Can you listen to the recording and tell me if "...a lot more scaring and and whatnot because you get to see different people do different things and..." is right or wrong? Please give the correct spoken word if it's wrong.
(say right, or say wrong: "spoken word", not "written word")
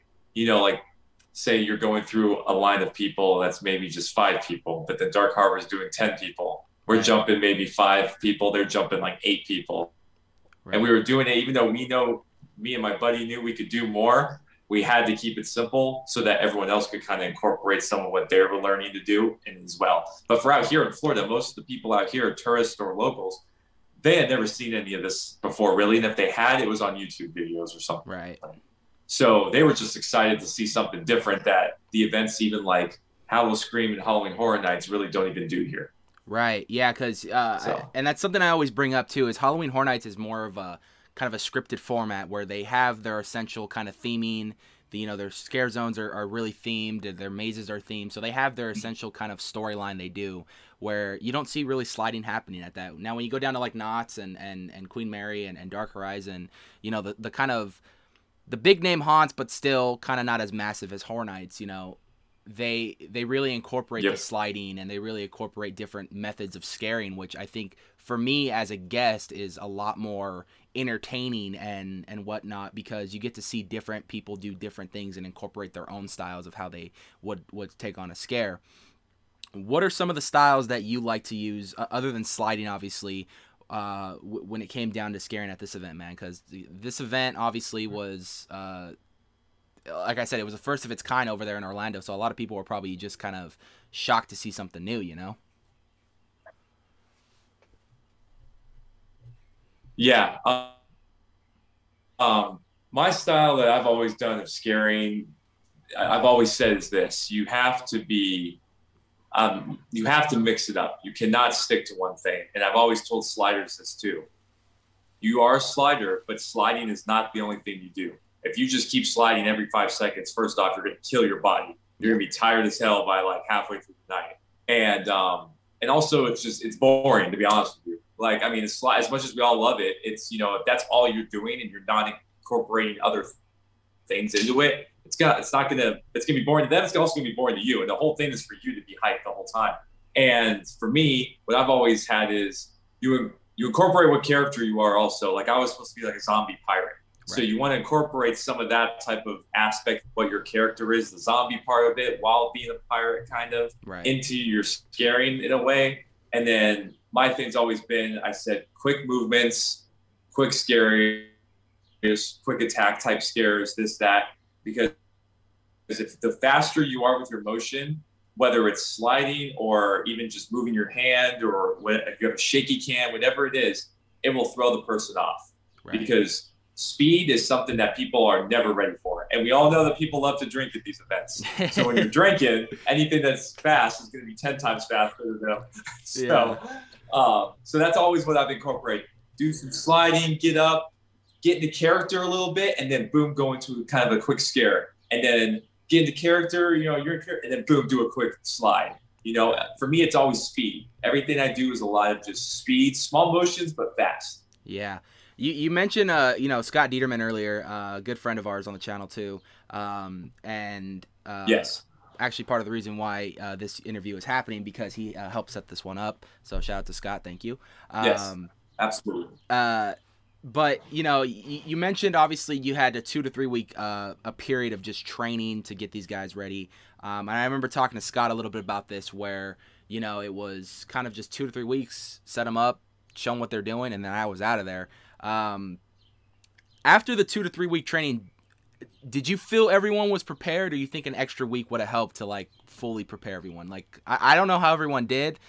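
wrong: "entertaining", not "scaring".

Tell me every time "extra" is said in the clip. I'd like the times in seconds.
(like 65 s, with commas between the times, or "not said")
241 s.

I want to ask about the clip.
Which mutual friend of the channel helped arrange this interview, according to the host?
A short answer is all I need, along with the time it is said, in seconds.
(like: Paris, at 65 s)
Scott Dieterman, at 206 s.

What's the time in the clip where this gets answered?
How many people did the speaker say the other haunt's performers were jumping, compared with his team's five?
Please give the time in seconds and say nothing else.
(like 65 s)
9 s.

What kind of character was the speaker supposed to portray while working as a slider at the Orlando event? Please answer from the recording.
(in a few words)
zombie pirate.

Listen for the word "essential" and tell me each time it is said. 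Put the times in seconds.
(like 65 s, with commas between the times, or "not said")
43 s, 48 s.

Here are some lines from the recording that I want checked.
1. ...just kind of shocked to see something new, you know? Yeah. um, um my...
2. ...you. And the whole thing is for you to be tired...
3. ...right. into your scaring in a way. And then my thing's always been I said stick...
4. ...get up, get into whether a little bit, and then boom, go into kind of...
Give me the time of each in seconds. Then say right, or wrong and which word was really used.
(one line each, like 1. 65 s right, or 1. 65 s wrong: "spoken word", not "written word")
1. 92 s right
2. 137 s wrong: "hyped", not "tired"
3. 153 s wrong: "quick", not "stick"
4. 190 s wrong: "character", not "whether".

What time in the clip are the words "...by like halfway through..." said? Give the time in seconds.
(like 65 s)
123 s.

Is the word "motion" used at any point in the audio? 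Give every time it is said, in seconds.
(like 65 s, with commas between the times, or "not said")
167 s, 203 s.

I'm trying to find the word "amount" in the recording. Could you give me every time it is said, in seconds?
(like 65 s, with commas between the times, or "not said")
not said.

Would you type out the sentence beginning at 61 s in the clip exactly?
You know, they they really incorporate yep.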